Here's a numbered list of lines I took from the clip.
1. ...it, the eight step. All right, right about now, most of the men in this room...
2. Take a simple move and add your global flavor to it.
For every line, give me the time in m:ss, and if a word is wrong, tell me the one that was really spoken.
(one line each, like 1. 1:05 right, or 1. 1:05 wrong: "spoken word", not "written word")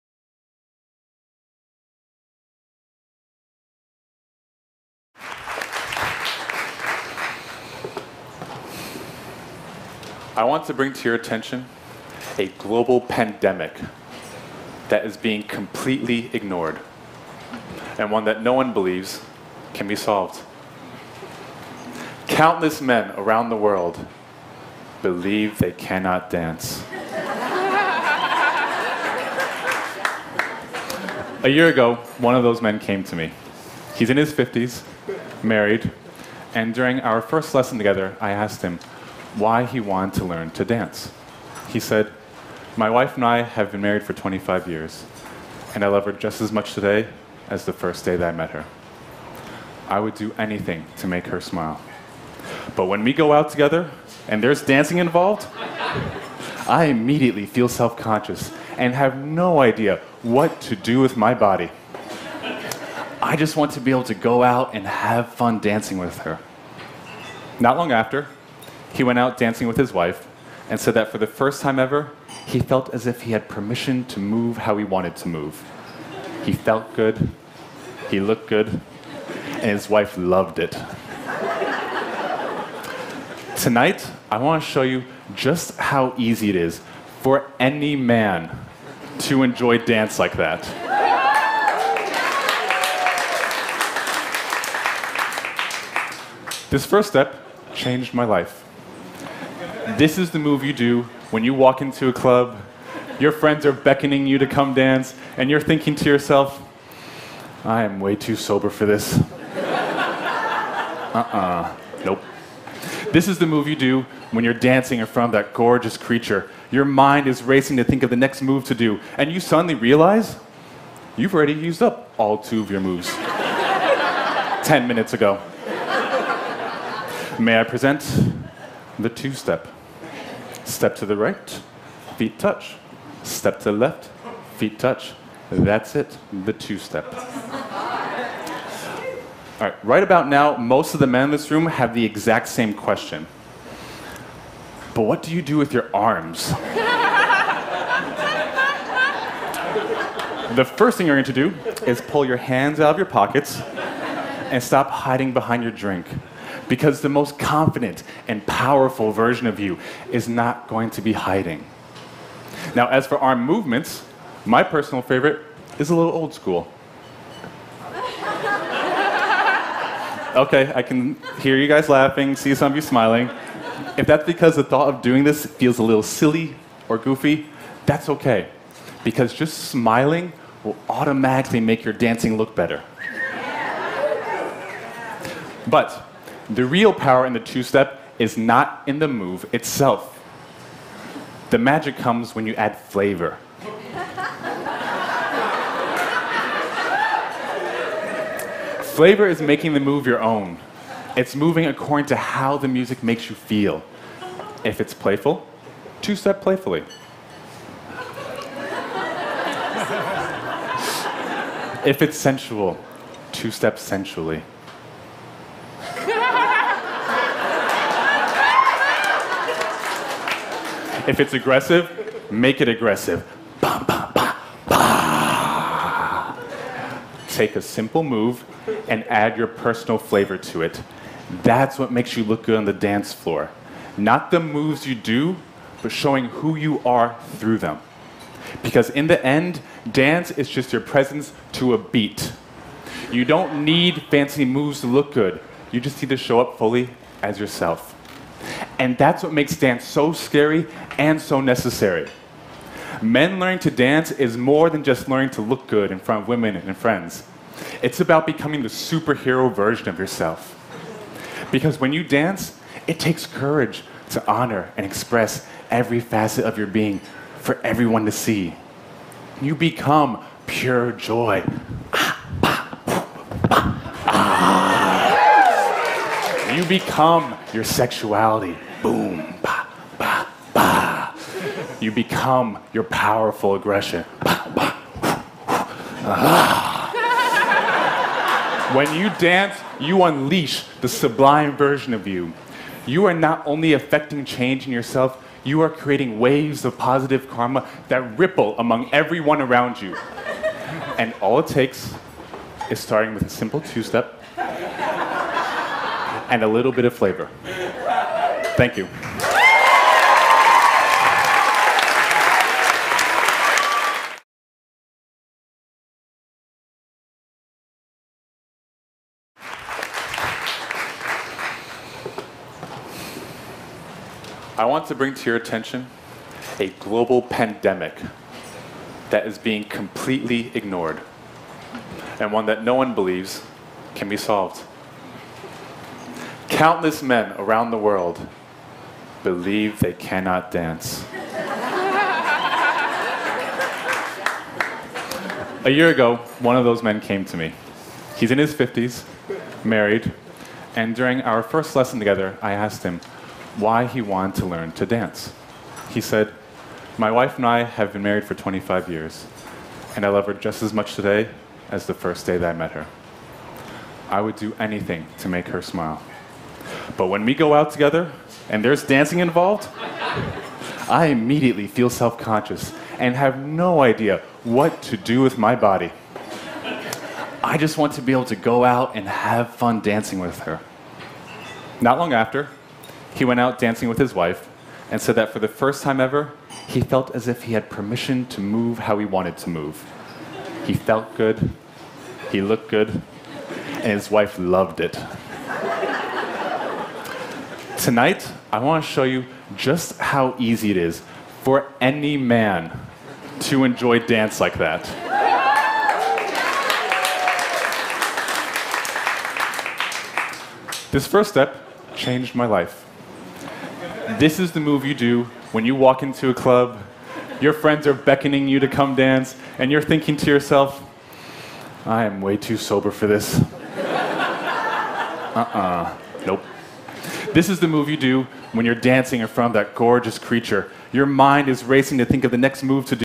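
1. 2:15 wrong: "two", not "eight"
2. 3:47 wrong: "personal", not "global".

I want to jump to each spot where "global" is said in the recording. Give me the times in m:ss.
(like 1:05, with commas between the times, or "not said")
0:12, 5:26.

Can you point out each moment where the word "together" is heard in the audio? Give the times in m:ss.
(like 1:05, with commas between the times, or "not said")
0:37, 0:53, 5:51, 6:07.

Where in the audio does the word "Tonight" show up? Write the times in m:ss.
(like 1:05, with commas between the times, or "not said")
1:23, 6:37.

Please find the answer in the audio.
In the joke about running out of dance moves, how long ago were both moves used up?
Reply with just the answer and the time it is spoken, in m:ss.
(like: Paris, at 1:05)
10 minutes, at 2:04.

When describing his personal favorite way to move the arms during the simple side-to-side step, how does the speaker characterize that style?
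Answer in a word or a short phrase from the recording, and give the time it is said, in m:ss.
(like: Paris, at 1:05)
old school, at 2:46.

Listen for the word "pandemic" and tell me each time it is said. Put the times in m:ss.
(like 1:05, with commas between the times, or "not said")
0:13, 5:27.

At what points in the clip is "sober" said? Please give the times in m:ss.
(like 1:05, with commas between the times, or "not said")
1:48, 7:02.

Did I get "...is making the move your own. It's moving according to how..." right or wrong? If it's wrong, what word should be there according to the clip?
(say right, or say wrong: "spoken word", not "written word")
right.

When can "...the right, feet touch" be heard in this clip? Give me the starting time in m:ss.
2:11.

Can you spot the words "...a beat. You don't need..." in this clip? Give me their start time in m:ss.
4:01.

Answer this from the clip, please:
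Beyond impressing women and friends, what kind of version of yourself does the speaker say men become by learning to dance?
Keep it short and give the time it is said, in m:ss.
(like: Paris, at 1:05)
superhero, at 4:18.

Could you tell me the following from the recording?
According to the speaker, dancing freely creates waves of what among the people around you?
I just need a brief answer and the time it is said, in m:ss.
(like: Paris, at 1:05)
positive karma, at 4:56.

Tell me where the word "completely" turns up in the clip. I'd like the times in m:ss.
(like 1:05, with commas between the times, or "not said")
0:15, 5:29.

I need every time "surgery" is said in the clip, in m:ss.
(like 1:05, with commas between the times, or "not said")
not said.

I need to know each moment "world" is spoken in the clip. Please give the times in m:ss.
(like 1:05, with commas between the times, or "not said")
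0:23, 5:37.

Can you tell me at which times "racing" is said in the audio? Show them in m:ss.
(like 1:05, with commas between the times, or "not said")
1:57, 7:11.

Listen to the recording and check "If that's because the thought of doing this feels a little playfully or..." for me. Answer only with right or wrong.
wrong.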